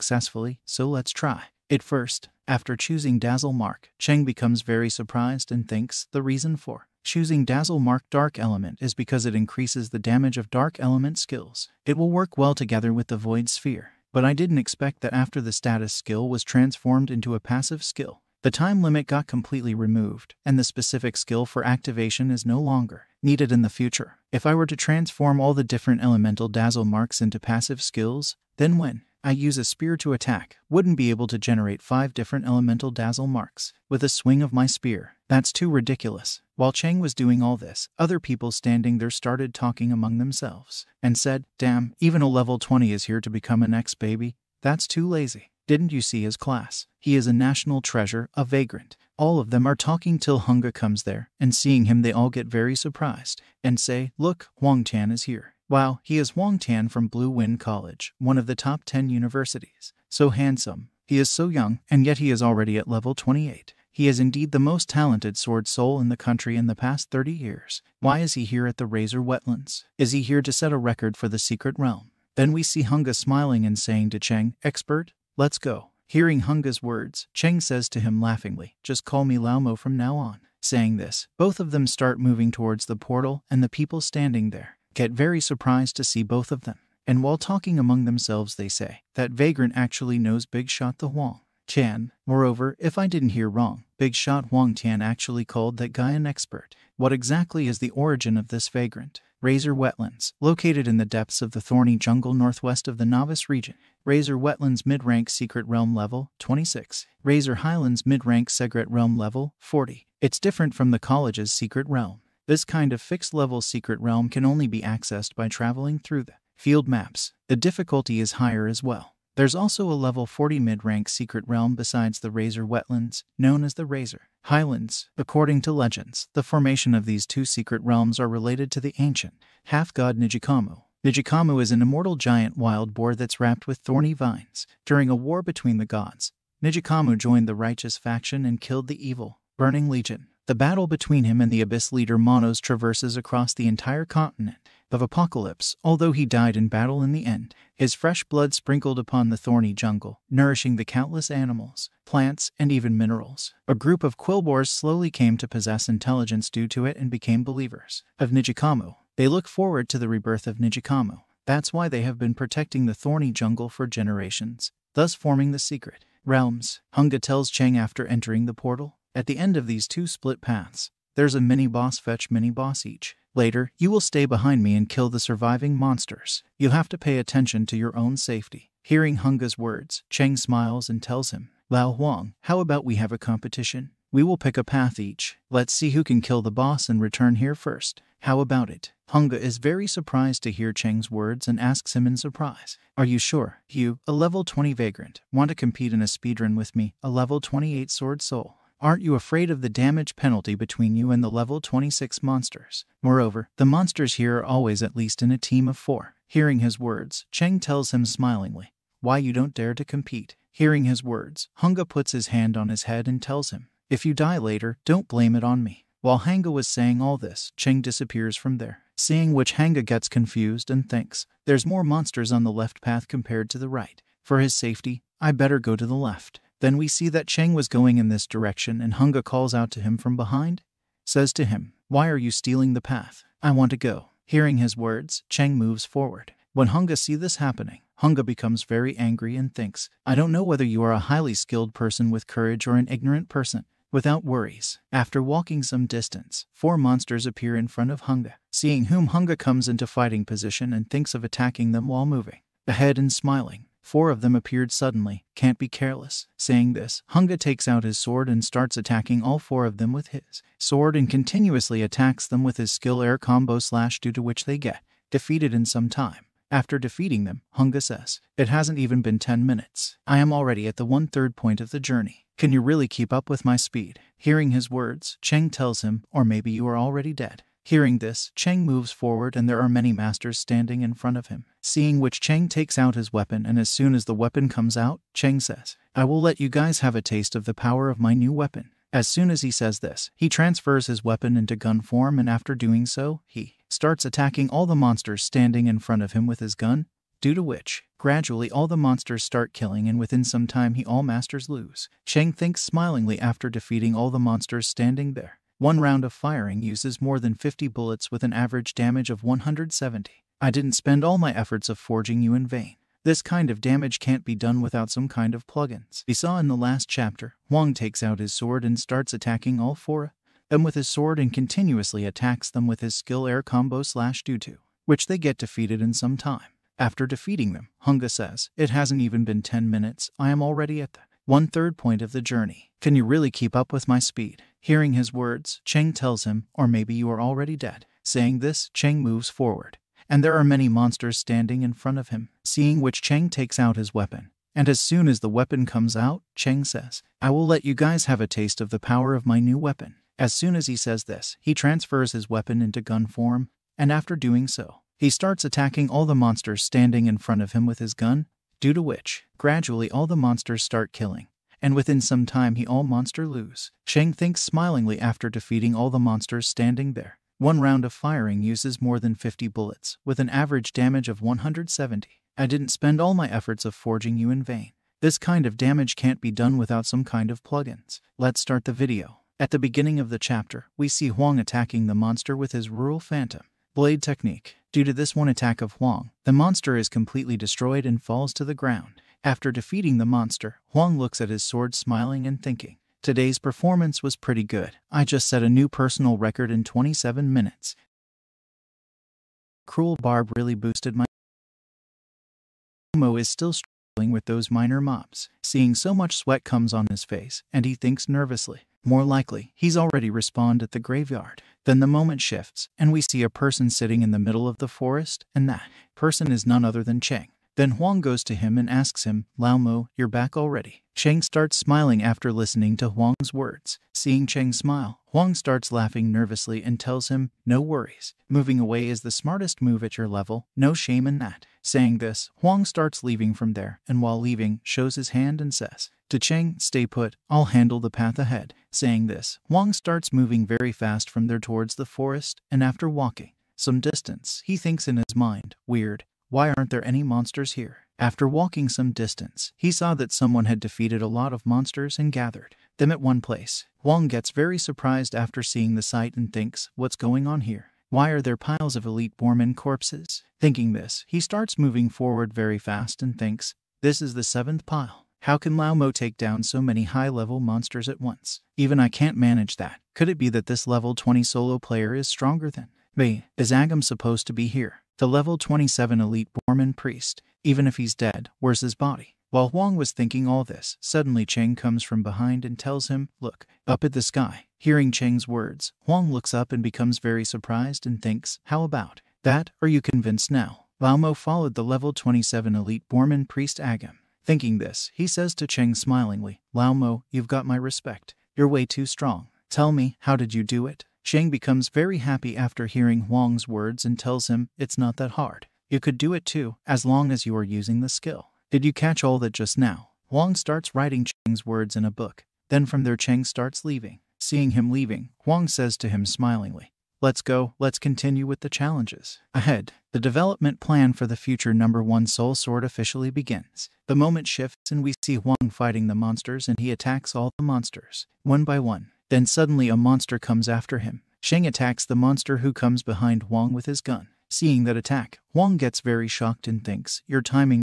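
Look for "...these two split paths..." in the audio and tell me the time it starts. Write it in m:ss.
2:49.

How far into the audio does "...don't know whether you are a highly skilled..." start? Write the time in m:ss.
4:00.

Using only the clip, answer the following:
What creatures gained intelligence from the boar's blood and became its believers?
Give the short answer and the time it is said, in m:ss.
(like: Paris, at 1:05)
Quillboars, at 2:34.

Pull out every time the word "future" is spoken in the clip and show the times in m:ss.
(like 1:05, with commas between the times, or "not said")
0:23, 8:41.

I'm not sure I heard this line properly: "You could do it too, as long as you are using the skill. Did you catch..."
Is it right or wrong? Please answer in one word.
right.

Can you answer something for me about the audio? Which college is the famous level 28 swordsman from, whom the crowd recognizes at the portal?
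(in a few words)
Blue Wind College.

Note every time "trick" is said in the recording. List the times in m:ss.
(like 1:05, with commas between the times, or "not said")
not said.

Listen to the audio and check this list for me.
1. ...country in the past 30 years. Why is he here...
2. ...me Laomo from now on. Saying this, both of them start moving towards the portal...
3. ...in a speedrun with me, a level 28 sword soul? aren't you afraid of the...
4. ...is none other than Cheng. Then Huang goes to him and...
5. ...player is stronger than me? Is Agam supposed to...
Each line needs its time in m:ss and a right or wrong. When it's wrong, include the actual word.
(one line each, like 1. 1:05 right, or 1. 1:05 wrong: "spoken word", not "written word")
1. 1:06 right
2. 1:19 right
3. 3:15 right
4. 6:56 right
5. 7:51 right.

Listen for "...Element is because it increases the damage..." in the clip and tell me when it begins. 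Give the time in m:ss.
0:08.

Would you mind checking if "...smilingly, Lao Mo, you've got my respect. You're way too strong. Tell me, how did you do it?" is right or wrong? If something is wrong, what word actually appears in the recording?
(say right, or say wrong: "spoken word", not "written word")
right.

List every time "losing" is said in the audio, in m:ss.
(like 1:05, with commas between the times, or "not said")
not said.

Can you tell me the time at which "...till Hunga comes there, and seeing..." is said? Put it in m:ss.
0:50.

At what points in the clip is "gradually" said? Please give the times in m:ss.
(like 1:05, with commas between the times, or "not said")
4:57, 5:59.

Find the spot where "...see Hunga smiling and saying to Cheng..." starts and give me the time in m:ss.
1:12.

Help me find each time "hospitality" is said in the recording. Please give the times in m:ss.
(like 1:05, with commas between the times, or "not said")
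not said.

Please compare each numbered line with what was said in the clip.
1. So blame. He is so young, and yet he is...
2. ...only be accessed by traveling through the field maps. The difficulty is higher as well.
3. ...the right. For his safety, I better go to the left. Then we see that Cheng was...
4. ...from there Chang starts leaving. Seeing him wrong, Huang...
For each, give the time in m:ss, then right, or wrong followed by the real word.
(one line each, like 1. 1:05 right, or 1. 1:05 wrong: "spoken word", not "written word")
1. 1:00 wrong: "handsome", not "blame"
2. 1:54 right
3. 3:43 right
4. 8:32 wrong: "leaving", not "wrong".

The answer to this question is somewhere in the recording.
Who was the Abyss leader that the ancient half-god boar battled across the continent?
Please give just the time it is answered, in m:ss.
2:22.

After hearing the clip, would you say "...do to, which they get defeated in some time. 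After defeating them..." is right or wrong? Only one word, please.
right.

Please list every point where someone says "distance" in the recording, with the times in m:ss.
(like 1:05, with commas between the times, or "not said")
4:05, 7:23, 7:28.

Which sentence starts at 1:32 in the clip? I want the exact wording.
Moreover, if I didn't hear wrong, Big Shot Huang Tian actually called that guy an expert.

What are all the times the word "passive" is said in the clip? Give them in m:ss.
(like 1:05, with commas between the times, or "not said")
0:17, 0:27.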